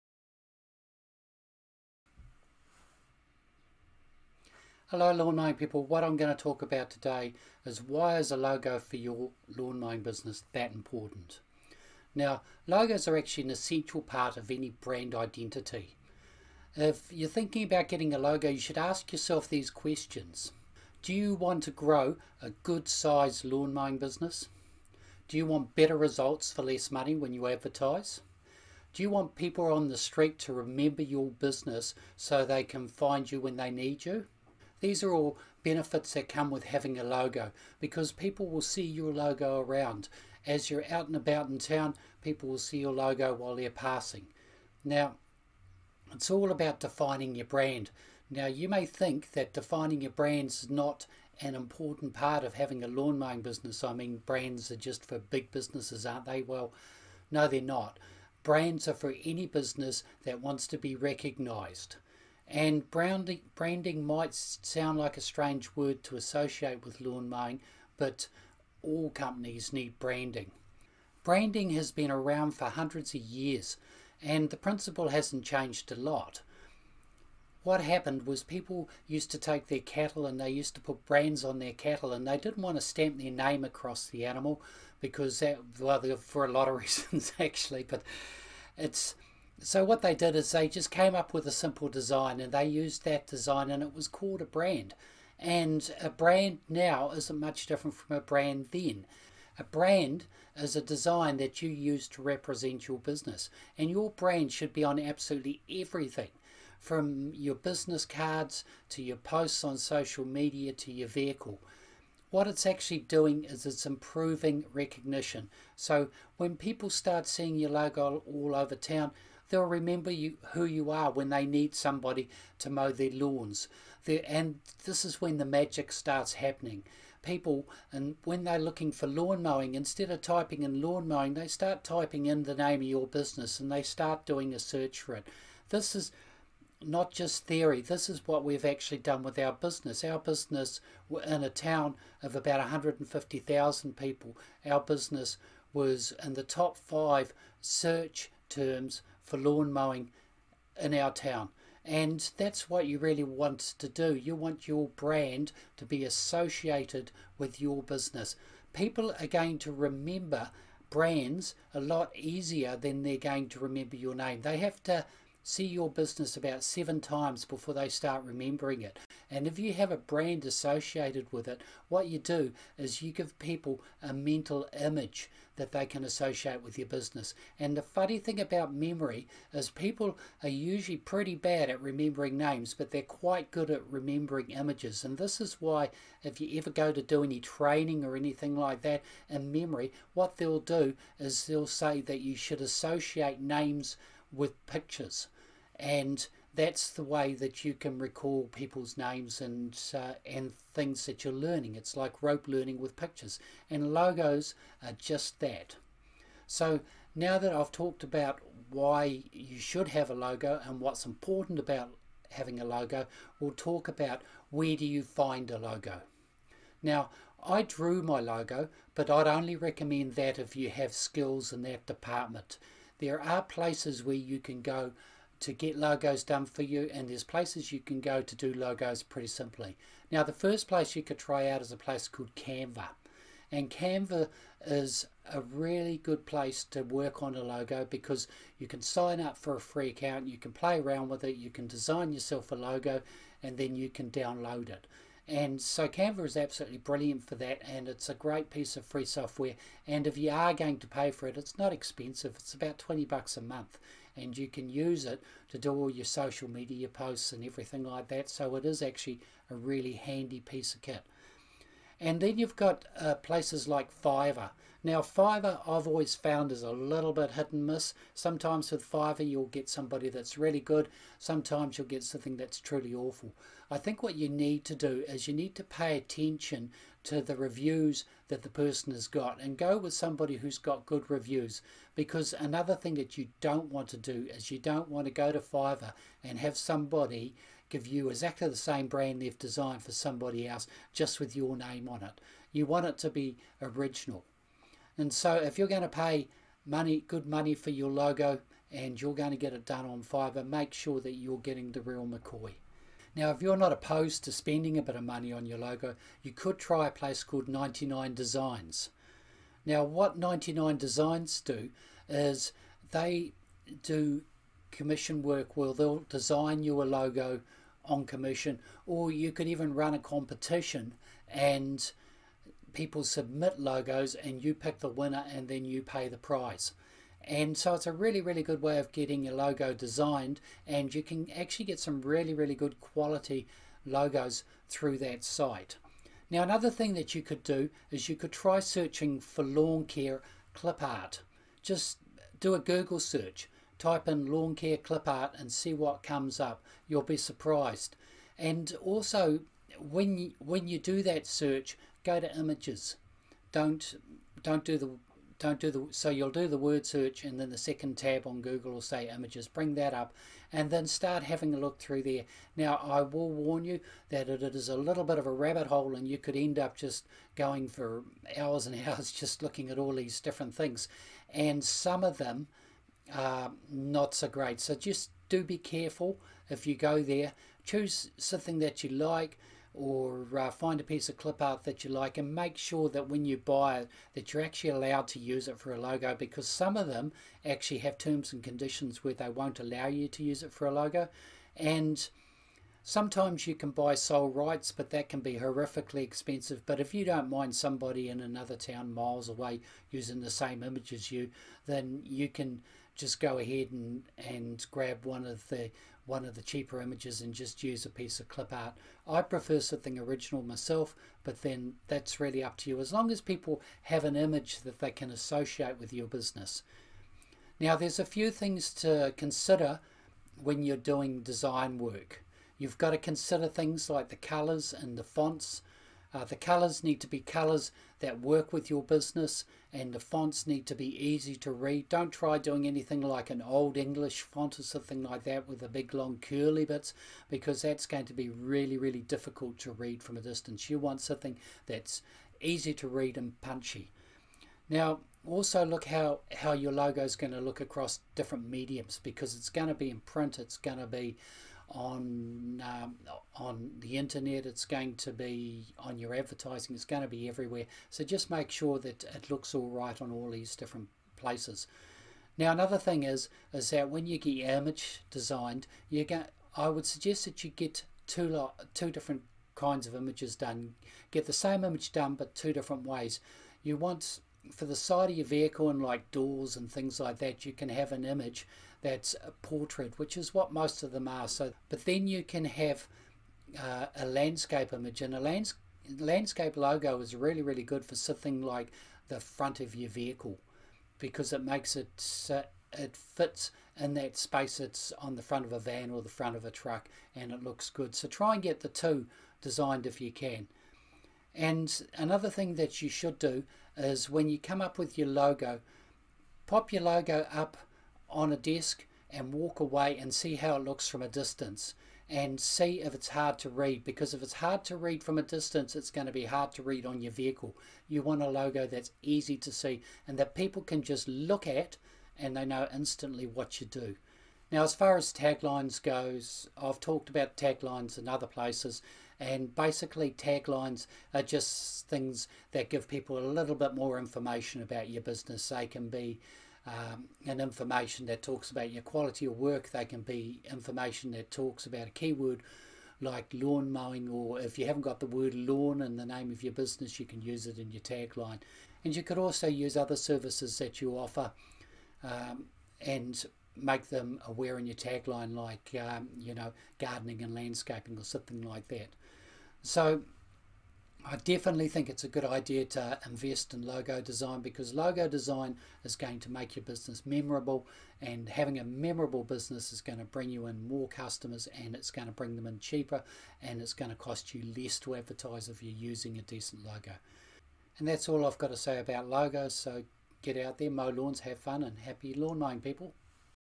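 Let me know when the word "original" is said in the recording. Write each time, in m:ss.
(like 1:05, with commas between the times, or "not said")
4:53, 6:49.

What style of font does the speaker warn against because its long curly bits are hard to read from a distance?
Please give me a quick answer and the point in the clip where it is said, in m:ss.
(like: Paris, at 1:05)
Old English, at 7:13.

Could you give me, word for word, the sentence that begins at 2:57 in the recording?
And the funny thing about memory is people are usually pretty bad at remembering names, but they're quite good at remembering images.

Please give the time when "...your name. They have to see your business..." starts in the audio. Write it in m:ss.
2:43.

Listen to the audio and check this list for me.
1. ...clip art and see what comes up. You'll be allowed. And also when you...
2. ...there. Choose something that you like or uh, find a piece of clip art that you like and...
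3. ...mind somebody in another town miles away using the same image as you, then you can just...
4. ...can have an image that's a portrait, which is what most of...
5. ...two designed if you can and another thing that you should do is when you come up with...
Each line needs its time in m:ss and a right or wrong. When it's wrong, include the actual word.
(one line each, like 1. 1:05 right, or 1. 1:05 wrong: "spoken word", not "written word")
1. 5:44 wrong: "surprised", not "allowed"
2. 6:17 right
3. 6:37 right
4. 7:57 right
5. 8:18 right.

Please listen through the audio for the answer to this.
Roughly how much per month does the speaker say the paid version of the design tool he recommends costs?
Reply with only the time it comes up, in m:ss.
4:12.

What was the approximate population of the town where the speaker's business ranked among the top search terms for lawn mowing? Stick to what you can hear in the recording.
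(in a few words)
150,000.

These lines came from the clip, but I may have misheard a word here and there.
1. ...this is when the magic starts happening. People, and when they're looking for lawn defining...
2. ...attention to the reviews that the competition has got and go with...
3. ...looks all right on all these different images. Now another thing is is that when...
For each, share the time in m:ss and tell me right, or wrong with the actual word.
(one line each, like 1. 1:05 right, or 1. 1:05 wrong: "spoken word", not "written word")
1. 2:04 wrong: "mowing", not "defining"
2. 4:35 wrong: "person", not "competition"
3. 7:39 wrong: "places", not "images".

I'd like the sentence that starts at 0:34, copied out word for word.
These are all benefits that come with having a logo because people will see your logo around.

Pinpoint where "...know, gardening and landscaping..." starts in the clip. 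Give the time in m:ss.
9:16.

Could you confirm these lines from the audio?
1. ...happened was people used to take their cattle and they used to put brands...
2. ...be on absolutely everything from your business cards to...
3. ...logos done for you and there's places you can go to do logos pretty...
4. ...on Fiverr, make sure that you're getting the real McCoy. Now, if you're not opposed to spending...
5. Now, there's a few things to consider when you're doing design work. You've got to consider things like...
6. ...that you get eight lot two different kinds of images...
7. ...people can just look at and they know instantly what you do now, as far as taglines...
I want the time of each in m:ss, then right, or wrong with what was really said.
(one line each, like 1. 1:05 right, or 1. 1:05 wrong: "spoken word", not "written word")
1. 1:17 right
2. 1:44 right
3. 3:45 right
4. 4:59 right
5. 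6:57 right
6. 7:47 wrong: "two", not "eight"
7. 8:40 right.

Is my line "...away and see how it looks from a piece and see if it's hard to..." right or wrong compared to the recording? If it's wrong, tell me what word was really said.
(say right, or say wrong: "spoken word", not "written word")
wrong: "distance", not "piece".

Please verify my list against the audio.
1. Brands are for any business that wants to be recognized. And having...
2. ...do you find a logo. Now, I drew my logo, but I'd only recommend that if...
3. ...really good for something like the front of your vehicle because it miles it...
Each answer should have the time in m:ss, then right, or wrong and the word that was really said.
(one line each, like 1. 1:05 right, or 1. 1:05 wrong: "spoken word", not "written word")
1. 0:58 wrong: "branding", not "having"
2. 3:34 right
3. 8:07 wrong: "makes", not "miles".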